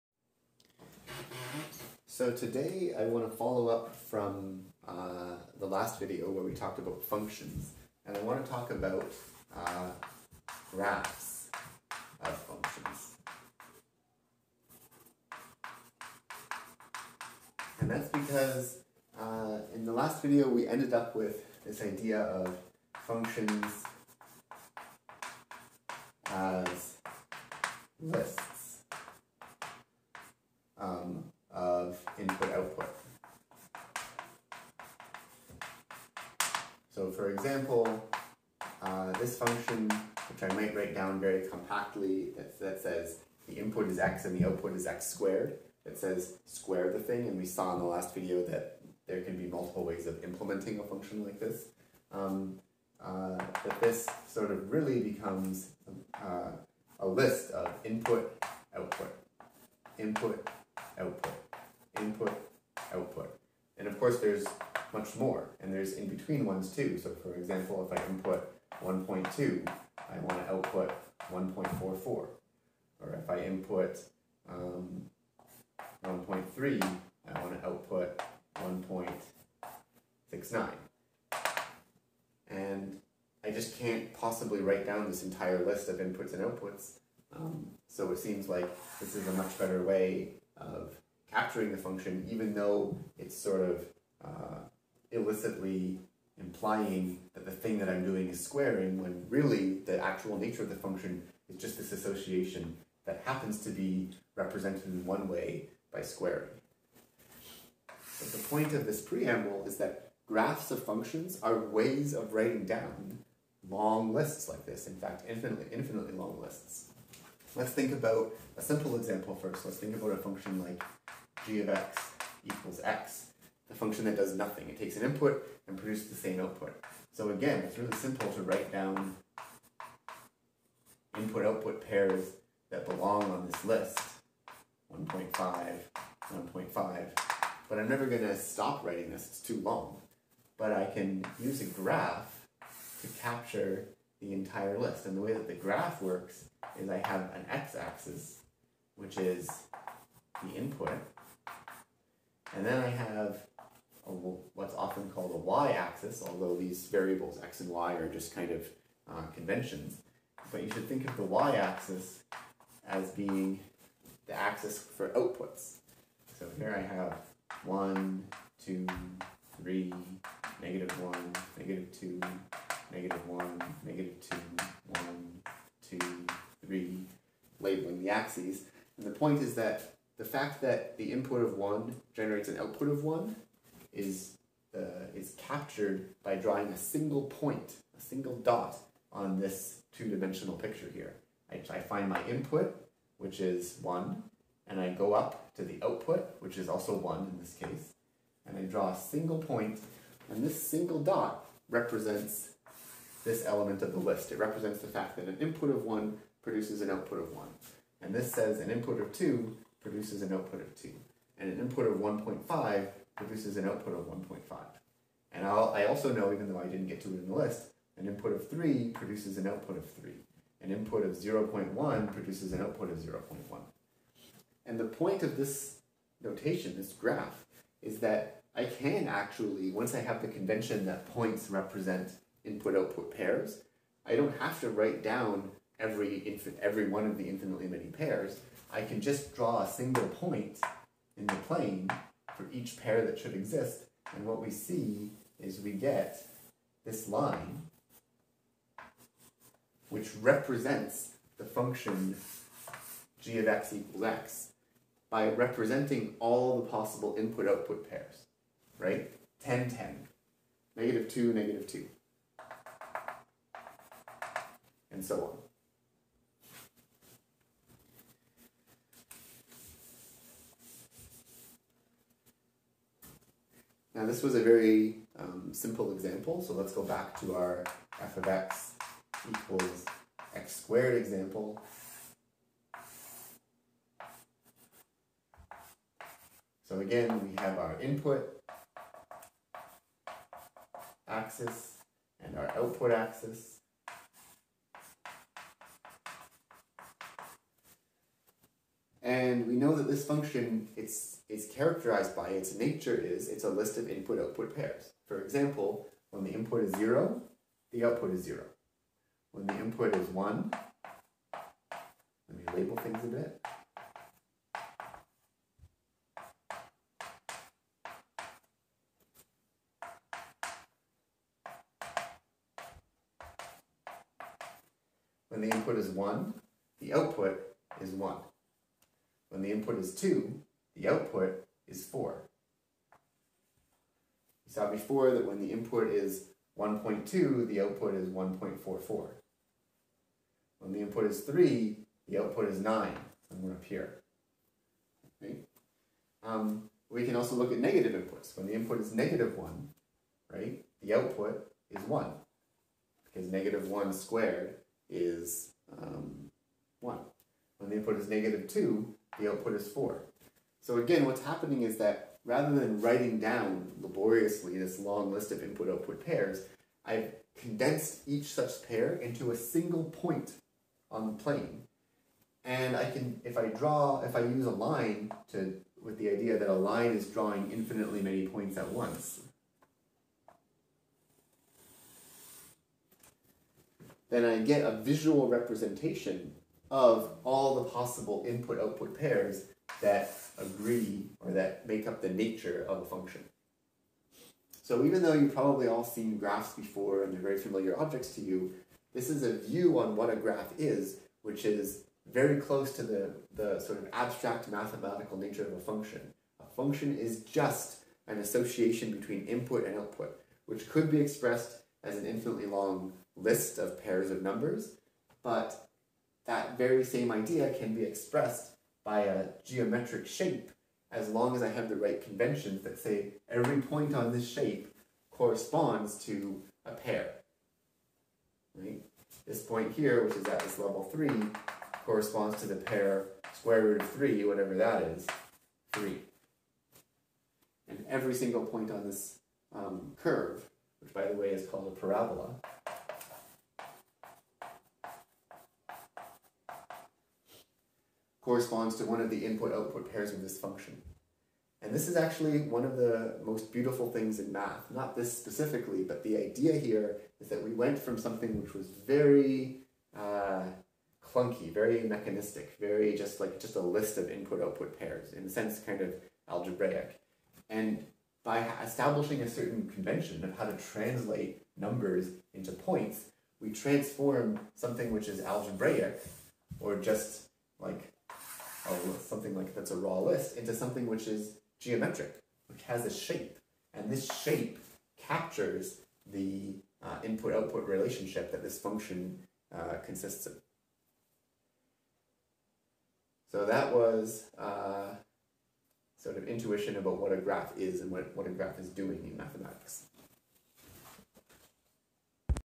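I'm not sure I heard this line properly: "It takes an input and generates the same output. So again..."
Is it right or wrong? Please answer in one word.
wrong.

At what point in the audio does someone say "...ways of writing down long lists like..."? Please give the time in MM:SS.
01:51.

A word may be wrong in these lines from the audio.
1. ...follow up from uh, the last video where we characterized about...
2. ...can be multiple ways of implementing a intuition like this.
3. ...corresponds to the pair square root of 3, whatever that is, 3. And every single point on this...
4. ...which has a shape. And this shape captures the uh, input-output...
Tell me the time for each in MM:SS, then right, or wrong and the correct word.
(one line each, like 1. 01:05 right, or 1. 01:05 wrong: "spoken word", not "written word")
1. 00:03 wrong: "talked", not "characterized"
2. 00:49 wrong: "function", not "intuition"
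3. 07:11 right
4. 08:02 right.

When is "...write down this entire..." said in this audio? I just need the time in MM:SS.
01:24.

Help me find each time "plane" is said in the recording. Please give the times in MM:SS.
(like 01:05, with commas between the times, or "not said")
04:01, 06:11.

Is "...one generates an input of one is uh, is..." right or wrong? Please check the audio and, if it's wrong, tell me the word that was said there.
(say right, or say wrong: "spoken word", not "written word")
wrong: "output", not "input".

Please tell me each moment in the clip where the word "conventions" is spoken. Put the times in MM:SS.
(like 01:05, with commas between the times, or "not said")
02:39, 03:50, 07:02, 07:49.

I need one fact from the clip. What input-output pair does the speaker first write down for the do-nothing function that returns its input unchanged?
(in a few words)
1.5, 1.5.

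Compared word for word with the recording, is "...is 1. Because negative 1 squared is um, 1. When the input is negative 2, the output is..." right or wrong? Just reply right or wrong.
right.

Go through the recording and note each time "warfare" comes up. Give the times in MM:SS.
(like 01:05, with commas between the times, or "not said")
not said.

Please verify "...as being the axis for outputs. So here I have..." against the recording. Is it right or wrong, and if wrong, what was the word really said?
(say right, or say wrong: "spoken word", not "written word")
right.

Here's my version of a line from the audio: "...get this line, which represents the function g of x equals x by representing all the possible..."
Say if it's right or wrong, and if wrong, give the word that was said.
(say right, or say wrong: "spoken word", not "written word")
right.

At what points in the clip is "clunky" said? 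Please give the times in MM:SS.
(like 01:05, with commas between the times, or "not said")
07:41.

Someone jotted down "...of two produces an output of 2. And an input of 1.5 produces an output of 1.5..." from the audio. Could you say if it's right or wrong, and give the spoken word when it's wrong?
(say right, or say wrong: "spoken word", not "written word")
right.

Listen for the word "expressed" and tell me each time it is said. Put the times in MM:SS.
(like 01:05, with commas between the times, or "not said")
06:51, 06:57.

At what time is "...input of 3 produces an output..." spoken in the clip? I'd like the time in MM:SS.
03:38.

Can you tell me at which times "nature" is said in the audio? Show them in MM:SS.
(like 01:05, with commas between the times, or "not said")
01:40, 05:02, 06:32, 06:45.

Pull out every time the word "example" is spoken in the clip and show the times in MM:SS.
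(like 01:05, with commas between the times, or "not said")
00:37, 01:07, 01:58, 04:35, 04:40, 05:05.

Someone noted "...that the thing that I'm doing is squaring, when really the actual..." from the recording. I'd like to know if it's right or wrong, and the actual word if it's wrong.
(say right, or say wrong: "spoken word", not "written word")
right.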